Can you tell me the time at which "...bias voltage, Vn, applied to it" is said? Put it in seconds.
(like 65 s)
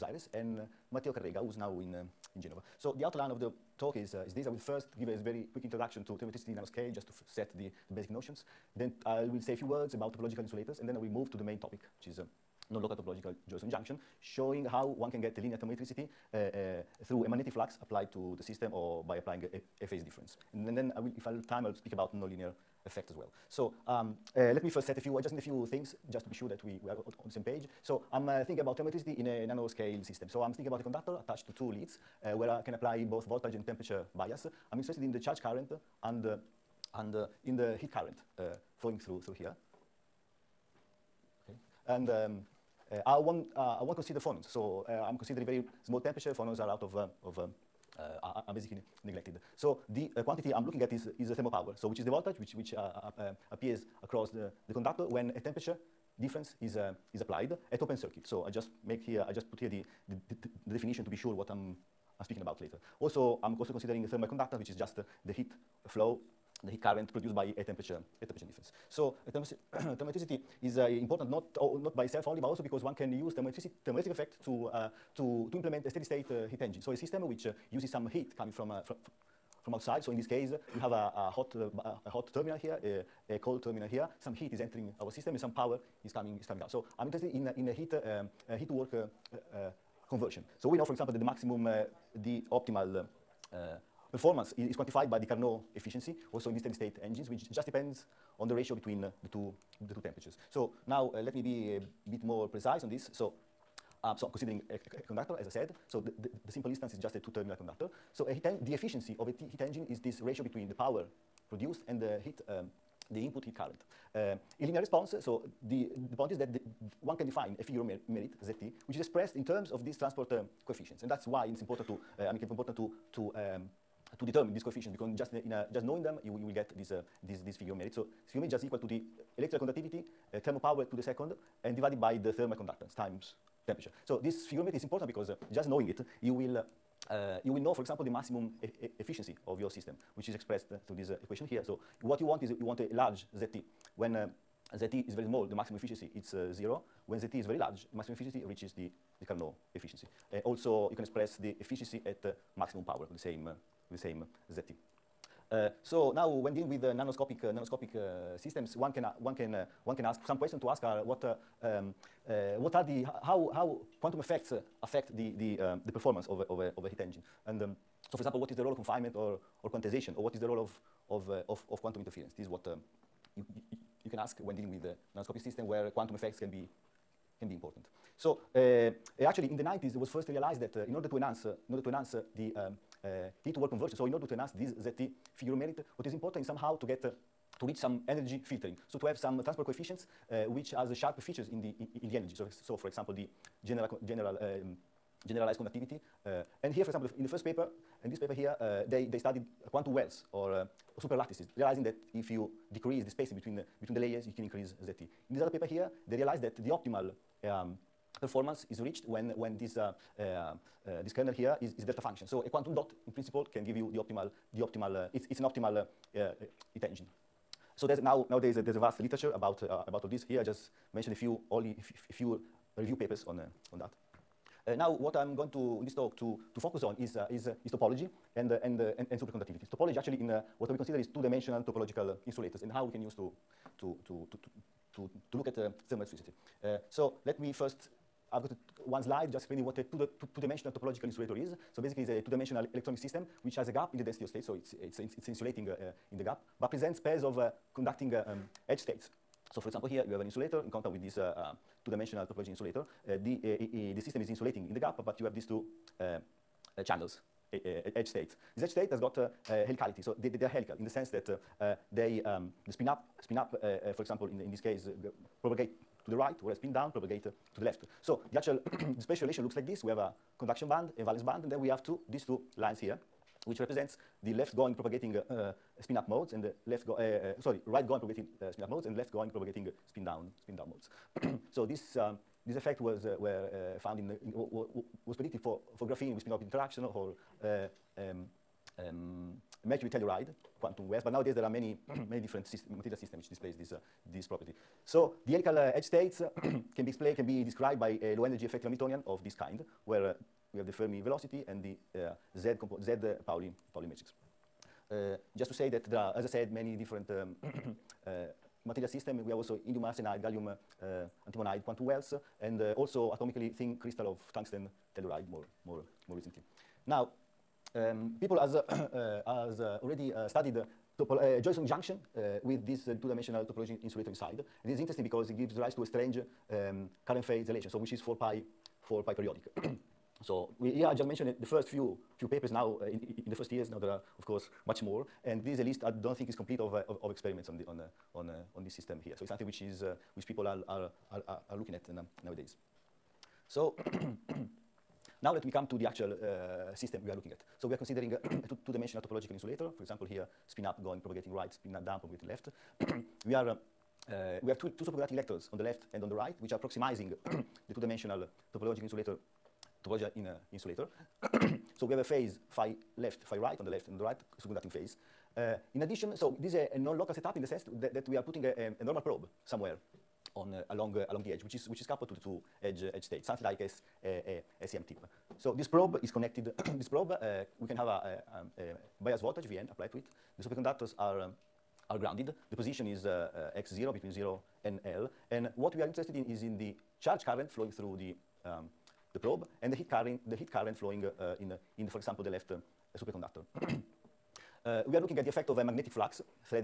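379 s.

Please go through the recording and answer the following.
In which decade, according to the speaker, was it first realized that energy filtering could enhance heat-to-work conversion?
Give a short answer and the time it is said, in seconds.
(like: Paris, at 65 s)
the 90s, at 179 s.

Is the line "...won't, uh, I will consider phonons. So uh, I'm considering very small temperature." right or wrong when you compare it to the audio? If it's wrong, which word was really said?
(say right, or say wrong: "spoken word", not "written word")
right.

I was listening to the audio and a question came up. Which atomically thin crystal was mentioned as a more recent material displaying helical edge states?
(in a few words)
tungsten telluride.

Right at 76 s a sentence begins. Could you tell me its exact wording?
So a system which uh, uses some heat coming from, uh, from, from outside.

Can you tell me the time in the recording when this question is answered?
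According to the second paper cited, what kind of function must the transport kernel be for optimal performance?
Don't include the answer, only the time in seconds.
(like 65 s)
211 s.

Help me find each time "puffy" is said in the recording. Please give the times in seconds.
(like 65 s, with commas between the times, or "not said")
not said.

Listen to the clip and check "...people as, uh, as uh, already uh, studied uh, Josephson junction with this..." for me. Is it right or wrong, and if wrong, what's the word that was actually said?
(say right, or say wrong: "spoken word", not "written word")
right.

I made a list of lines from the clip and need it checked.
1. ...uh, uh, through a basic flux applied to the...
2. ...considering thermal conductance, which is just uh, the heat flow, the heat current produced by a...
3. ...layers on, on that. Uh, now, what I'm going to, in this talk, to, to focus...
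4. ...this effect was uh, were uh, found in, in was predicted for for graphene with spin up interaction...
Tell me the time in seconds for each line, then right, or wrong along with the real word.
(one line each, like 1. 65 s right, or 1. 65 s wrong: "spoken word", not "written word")
1. 16 s wrong: "magnetic", not "basic"
2. 63 s right
3. 222 s wrong: "papers", not "layers"
4. 282 s right.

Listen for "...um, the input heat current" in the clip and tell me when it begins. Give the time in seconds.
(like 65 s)
112 s.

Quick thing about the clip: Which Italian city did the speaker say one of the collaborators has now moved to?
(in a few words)
Genova.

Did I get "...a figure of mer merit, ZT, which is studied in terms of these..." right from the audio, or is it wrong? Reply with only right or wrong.
wrong.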